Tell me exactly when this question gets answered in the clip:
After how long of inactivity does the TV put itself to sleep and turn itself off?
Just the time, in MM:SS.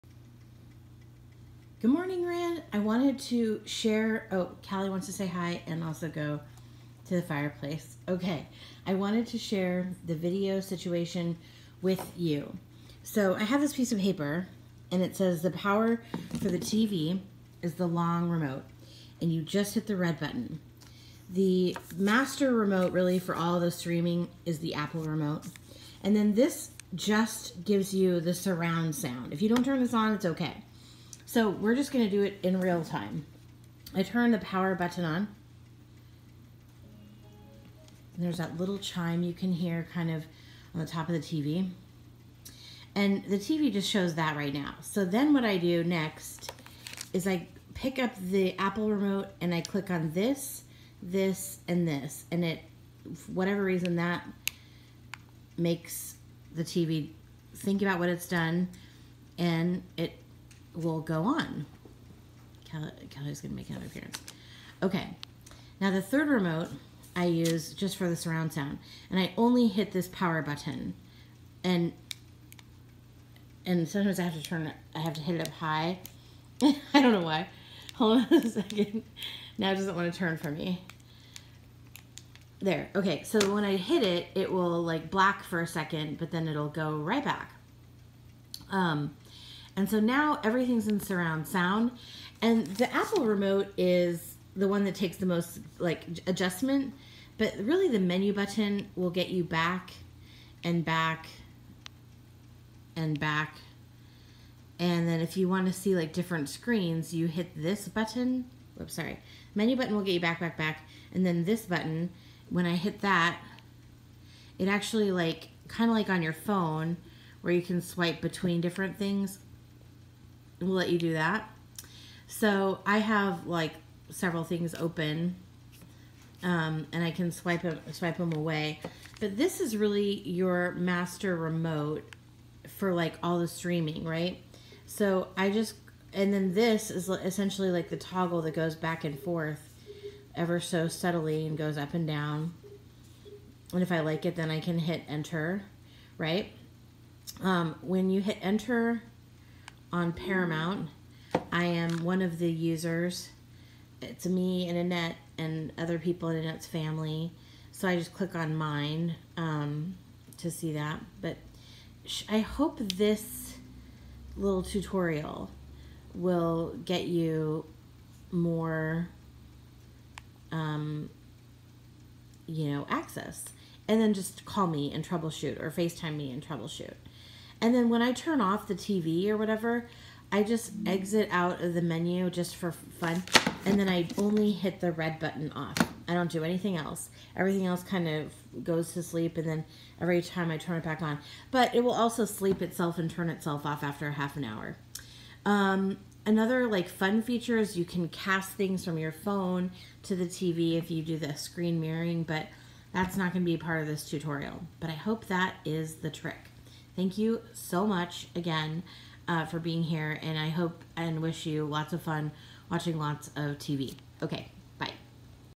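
03:14.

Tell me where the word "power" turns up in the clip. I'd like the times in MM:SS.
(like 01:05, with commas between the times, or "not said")
00:15, 00:34, 01:10.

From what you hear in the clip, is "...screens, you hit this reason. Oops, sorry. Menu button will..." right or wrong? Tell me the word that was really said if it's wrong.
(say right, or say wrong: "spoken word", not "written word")
wrong: "button", not "reason".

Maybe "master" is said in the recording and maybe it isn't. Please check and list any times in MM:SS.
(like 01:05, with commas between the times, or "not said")
00:21, 02:10.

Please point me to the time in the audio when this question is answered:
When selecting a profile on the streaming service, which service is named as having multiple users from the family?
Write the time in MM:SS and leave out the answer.
02:30.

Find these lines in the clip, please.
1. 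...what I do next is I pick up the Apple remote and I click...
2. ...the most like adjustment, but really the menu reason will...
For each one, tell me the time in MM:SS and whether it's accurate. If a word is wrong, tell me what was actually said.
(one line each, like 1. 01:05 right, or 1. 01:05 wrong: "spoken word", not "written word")
1. 00:45 right
2. 01:35 wrong: "button", not "reason".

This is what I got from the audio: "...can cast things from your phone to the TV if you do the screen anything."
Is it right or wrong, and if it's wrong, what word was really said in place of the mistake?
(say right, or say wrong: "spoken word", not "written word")
wrong: "mirroring", not "anything".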